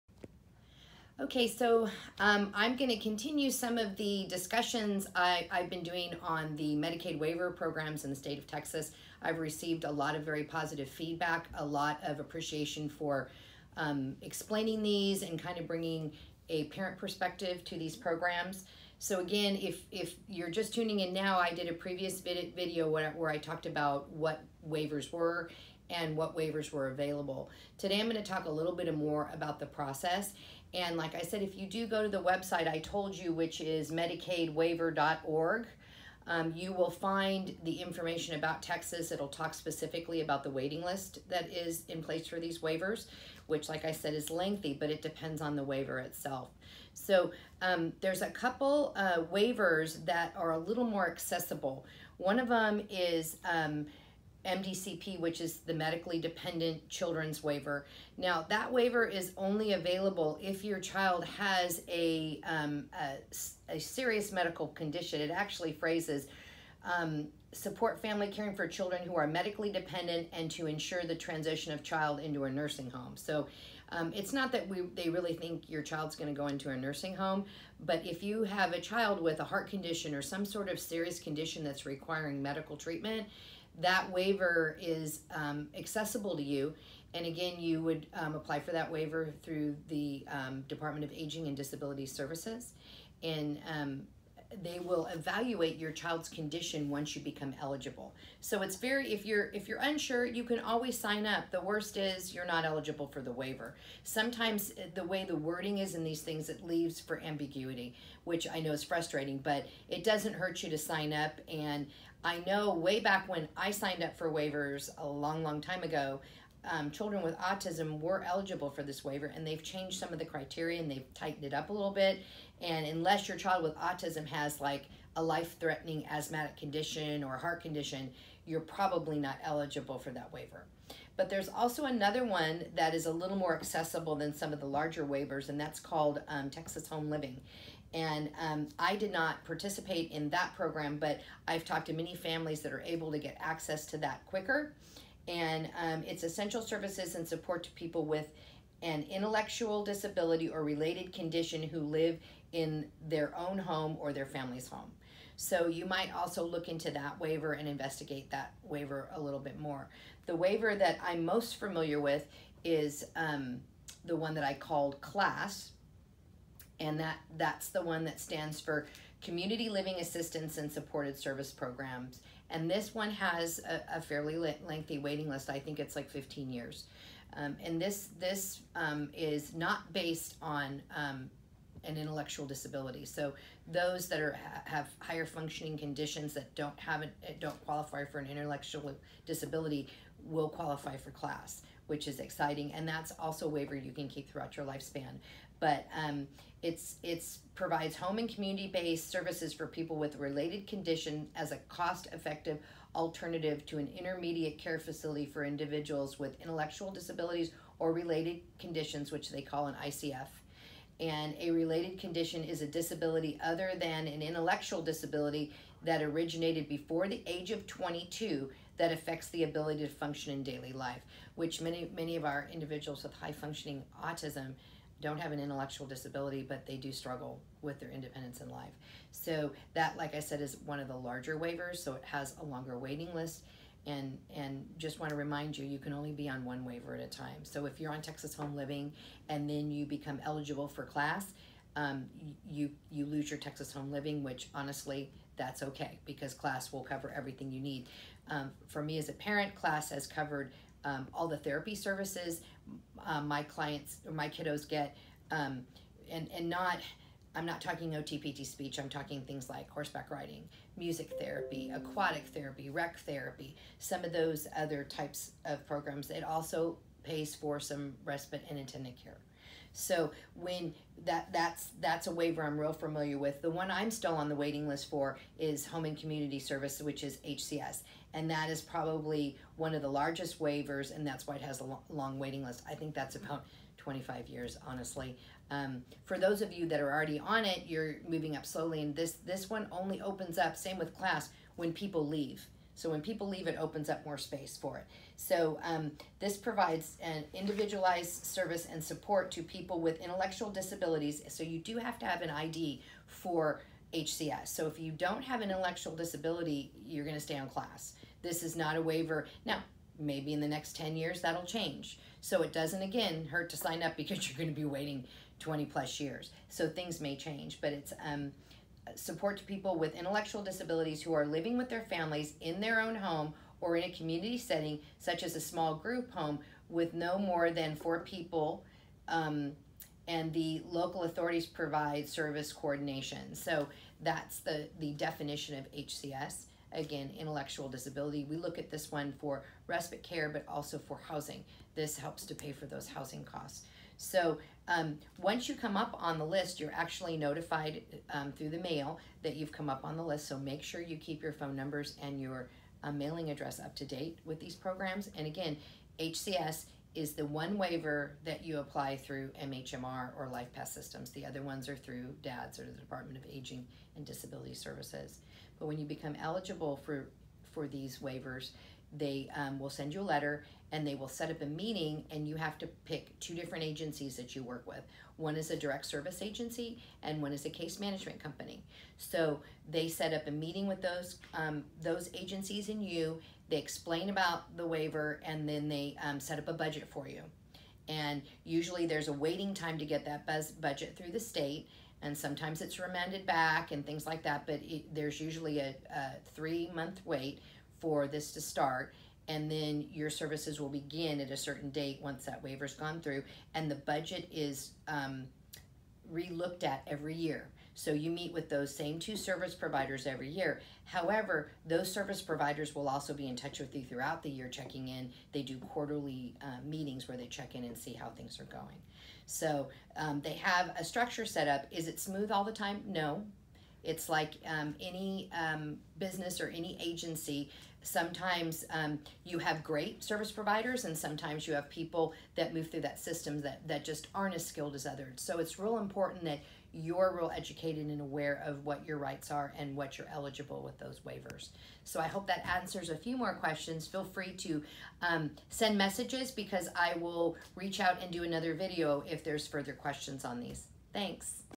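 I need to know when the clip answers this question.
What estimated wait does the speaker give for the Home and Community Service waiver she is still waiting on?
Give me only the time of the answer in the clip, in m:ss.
4:43.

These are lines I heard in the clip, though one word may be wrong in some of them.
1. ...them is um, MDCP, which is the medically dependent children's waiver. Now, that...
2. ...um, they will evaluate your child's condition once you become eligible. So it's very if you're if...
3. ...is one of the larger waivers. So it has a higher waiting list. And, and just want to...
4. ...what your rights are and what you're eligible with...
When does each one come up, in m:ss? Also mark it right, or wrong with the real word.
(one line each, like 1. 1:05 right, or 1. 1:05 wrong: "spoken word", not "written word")
1. 0:52 right
2. 1:33 right
3. 3:50 wrong: "longer", not "higher"
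4. 7:18 right.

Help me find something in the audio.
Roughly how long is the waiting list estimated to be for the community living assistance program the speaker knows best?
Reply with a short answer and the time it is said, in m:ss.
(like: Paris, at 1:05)
15 years, at 2:56.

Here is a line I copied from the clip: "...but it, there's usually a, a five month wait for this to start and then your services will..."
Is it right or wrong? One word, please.
wrong.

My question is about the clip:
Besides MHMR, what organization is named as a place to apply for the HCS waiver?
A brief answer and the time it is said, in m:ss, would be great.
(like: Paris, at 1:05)
LifePath Systems, at 6:00.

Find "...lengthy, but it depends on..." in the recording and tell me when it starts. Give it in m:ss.
0:44.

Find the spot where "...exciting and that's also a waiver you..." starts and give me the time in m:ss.
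3:12.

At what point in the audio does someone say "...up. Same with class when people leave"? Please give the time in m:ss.
4:50.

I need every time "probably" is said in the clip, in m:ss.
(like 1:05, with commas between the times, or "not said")
2:08, 4:38.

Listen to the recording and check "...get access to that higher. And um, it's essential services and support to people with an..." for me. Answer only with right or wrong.
wrong.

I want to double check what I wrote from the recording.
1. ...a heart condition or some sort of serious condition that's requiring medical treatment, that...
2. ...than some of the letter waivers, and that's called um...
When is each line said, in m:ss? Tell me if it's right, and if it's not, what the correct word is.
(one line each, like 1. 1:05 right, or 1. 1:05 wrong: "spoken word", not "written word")
1. 1:19 right
2. 2:14 wrong: "larger", not "letter".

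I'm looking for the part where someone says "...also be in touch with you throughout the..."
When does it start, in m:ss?
6:52.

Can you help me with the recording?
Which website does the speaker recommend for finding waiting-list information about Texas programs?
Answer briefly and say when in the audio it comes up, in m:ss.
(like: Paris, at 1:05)
medicaidwaiver.org, at 0:33.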